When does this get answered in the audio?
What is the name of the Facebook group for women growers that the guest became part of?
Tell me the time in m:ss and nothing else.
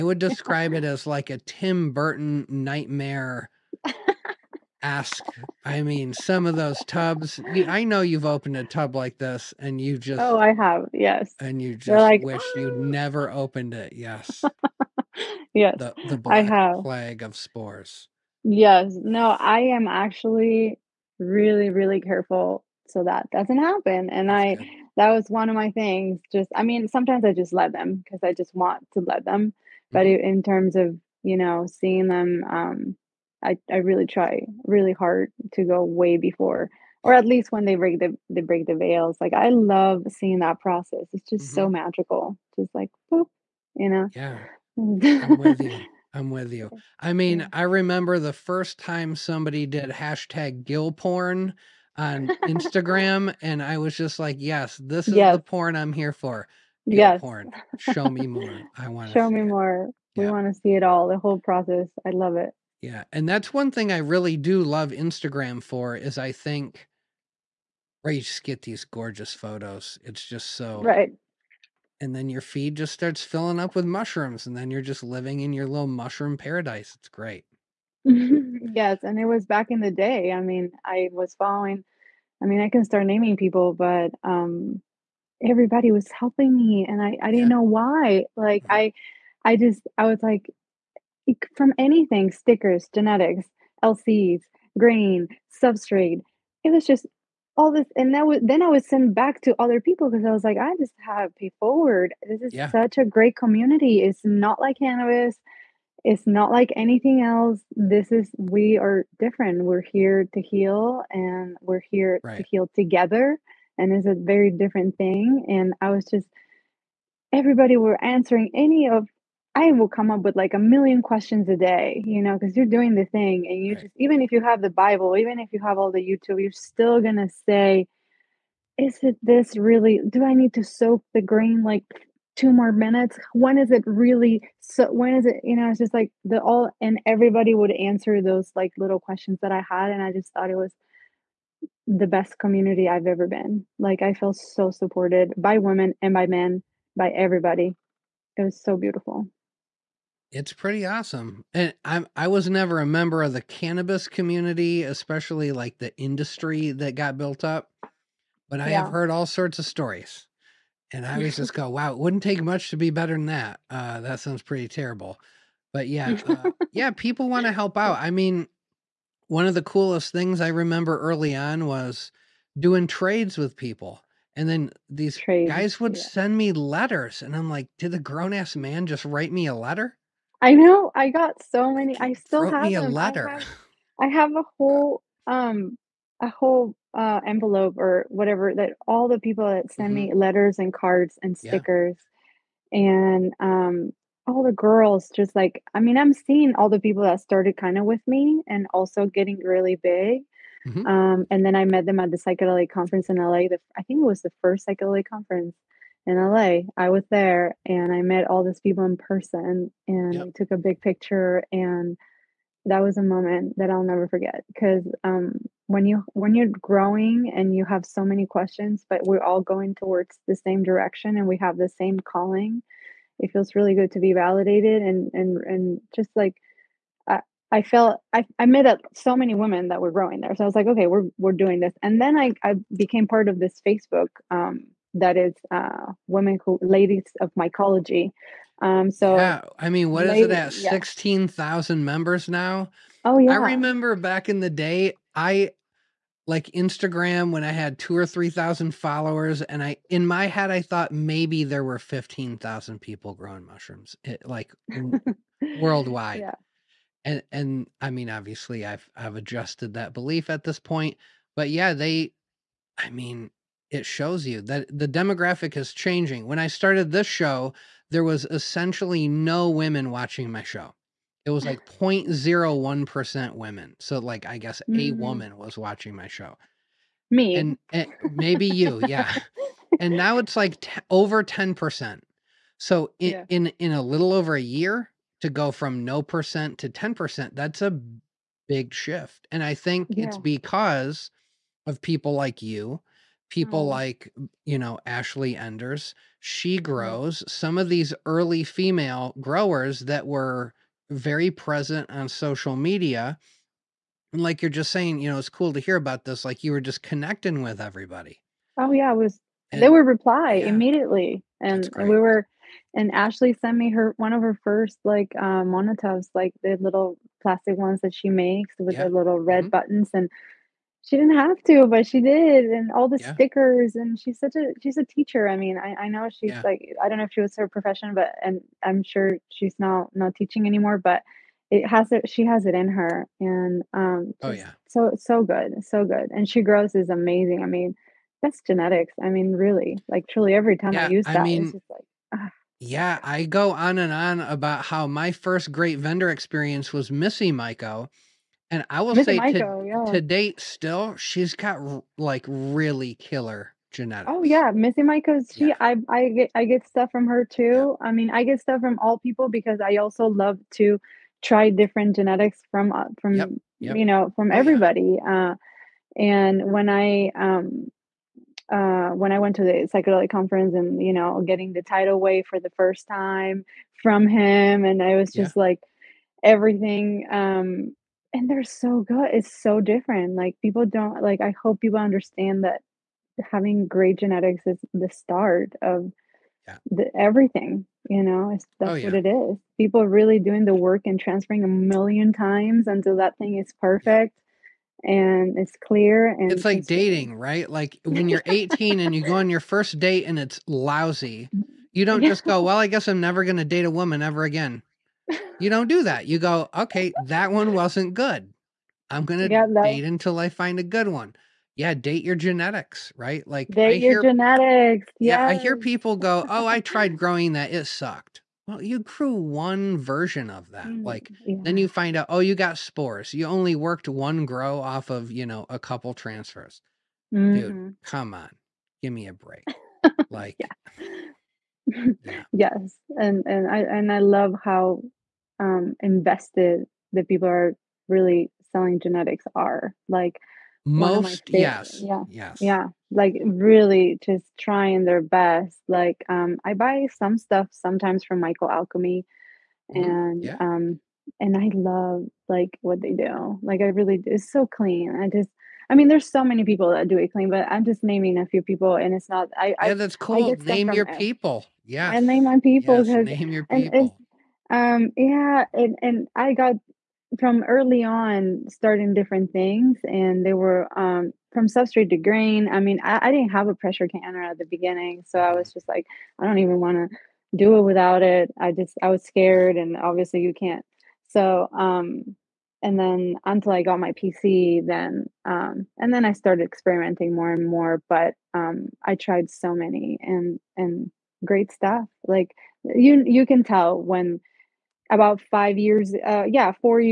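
3:56.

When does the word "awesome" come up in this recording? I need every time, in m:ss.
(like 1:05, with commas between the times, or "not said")
2:30.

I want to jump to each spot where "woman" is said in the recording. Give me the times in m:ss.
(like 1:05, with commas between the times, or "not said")
4:34, 6:43.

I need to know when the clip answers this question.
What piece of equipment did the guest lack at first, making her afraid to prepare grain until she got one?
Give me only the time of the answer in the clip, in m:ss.
7:53.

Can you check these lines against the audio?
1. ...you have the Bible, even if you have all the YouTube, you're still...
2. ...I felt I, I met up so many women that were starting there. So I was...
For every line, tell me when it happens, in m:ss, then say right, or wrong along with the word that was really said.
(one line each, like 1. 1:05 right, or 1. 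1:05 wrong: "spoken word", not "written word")
1. 2:04 right
2. 3:47 wrong: "growing", not "starting".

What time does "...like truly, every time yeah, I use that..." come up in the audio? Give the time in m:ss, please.
5:39.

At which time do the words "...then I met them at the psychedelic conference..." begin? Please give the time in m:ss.
3:21.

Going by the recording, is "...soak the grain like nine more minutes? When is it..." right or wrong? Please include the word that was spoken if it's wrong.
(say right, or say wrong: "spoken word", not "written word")
wrong: "two", not "nine".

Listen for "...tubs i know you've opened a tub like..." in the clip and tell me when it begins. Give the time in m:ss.
0:06.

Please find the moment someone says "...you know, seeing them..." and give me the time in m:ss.
0:31.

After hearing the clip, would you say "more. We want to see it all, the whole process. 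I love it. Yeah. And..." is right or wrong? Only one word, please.
right.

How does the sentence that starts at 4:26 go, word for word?
When I started this show, there was essentially no women watching my show.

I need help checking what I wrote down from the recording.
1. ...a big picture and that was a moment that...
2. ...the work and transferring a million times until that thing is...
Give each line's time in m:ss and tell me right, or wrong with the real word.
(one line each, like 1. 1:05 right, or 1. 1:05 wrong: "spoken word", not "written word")
1. 3:30 right
2. 6:30 right.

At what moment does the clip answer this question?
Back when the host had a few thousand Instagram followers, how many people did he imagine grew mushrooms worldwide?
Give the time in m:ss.
4:11.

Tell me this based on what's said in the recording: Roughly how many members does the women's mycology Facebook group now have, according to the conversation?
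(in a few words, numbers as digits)
16,000.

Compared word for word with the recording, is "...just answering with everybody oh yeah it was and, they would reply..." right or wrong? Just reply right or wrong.
wrong.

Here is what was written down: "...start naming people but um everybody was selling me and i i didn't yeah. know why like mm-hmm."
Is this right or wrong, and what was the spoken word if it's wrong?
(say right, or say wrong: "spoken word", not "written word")
wrong: "helping", not "selling".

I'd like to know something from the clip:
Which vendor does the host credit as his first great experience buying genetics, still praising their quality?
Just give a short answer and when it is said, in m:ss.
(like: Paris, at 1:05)
Missy Maiko, at 5:46.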